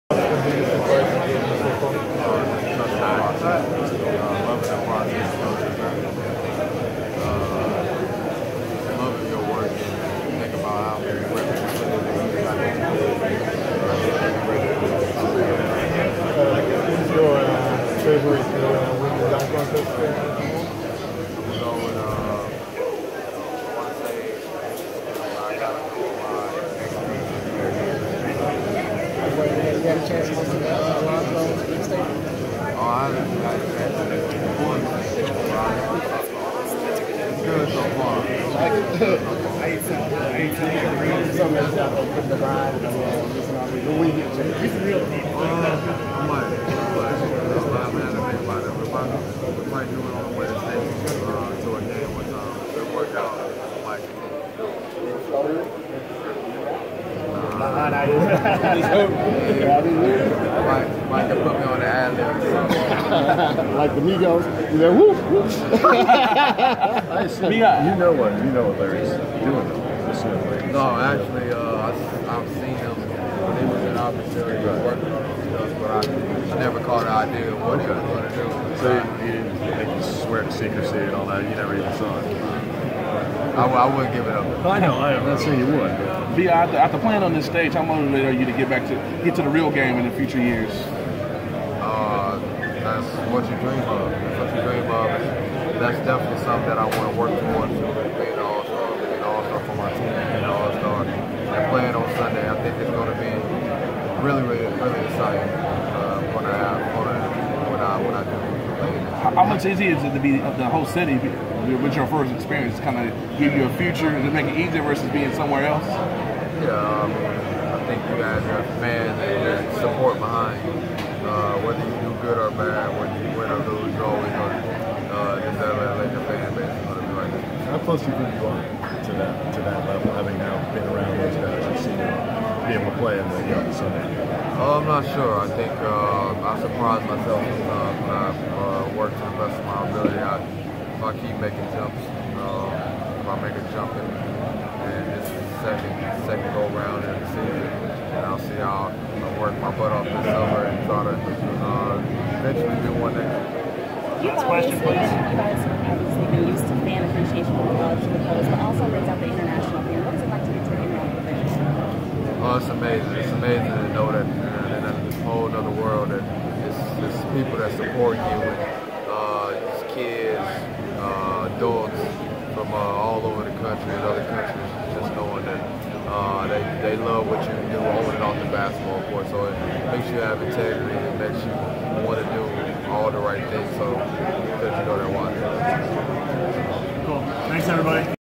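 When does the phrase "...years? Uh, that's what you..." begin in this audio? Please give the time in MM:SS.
01:30.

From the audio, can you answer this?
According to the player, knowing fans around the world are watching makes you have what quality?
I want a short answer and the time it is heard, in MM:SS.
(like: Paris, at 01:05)
Integrity, at 03:00.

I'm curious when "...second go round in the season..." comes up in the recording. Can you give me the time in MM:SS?
02:26.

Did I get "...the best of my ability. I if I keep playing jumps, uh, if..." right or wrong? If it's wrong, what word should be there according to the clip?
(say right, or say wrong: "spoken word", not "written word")
wrong: "making", not "playing".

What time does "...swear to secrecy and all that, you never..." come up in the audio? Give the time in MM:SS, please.
01:20.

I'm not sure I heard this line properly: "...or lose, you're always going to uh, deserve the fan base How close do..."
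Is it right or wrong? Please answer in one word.
right.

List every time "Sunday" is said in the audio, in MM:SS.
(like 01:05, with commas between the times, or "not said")
01:42, 02:13.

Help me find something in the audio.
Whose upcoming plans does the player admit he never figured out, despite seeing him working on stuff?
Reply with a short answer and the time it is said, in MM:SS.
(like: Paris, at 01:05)
Larry, at 01:08.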